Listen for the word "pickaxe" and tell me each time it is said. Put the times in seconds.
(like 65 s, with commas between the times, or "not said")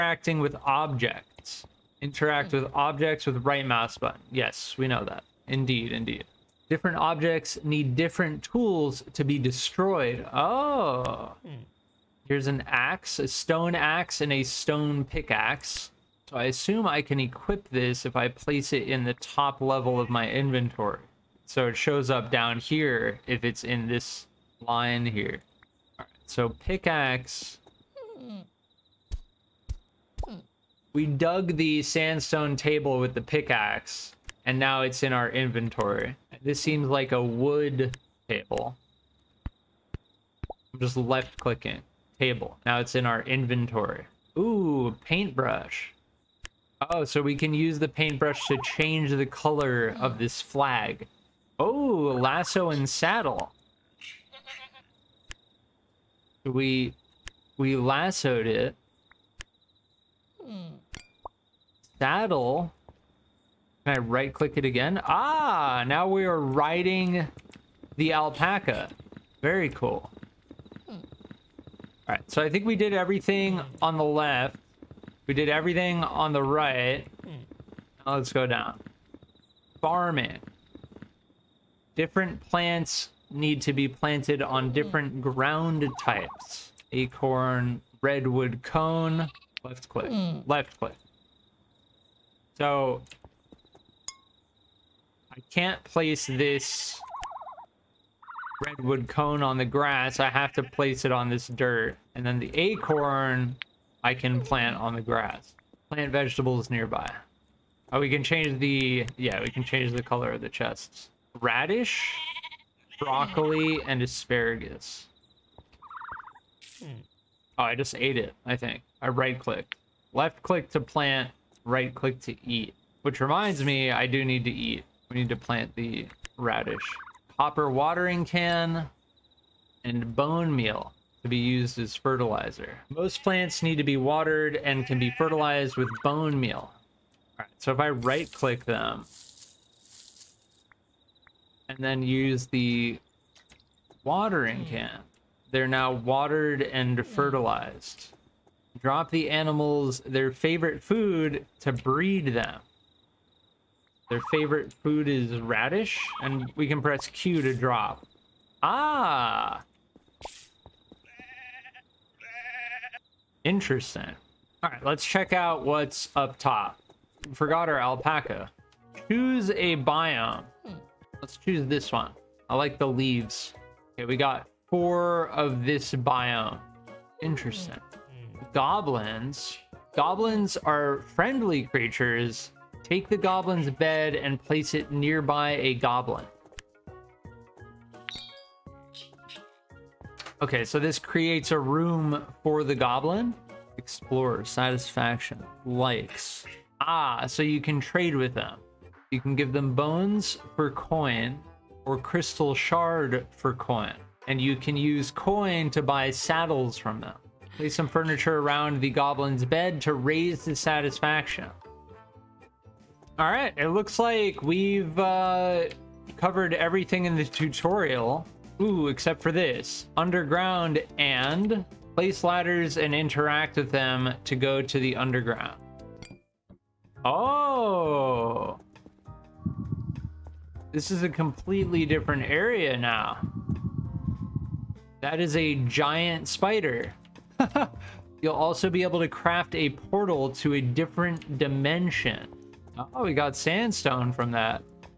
15 s, 26 s, 33 s.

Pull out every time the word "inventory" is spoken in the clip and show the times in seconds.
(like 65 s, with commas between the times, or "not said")
20 s, 35 s, 43 s.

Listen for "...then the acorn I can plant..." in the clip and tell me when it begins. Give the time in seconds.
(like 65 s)
102 s.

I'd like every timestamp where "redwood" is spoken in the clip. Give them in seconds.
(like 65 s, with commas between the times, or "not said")
88 s, 98 s.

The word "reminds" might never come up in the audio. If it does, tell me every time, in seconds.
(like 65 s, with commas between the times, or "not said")
123 s.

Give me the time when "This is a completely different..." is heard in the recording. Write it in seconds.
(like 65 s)
230 s.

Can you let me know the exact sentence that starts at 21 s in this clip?
So it shows up down here if it's in this line here.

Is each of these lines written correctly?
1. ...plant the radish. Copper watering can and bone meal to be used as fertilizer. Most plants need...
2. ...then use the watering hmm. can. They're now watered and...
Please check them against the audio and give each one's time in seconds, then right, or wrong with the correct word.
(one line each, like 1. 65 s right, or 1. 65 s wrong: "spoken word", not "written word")
1. 125 s right
2. 141 s right.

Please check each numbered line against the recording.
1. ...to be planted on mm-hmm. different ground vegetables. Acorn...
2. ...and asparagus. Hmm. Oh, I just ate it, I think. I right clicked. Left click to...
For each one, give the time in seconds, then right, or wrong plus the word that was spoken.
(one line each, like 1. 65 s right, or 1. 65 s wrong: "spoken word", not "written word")
1. 83 s wrong: "types", not "vegetables"
2. 113 s right.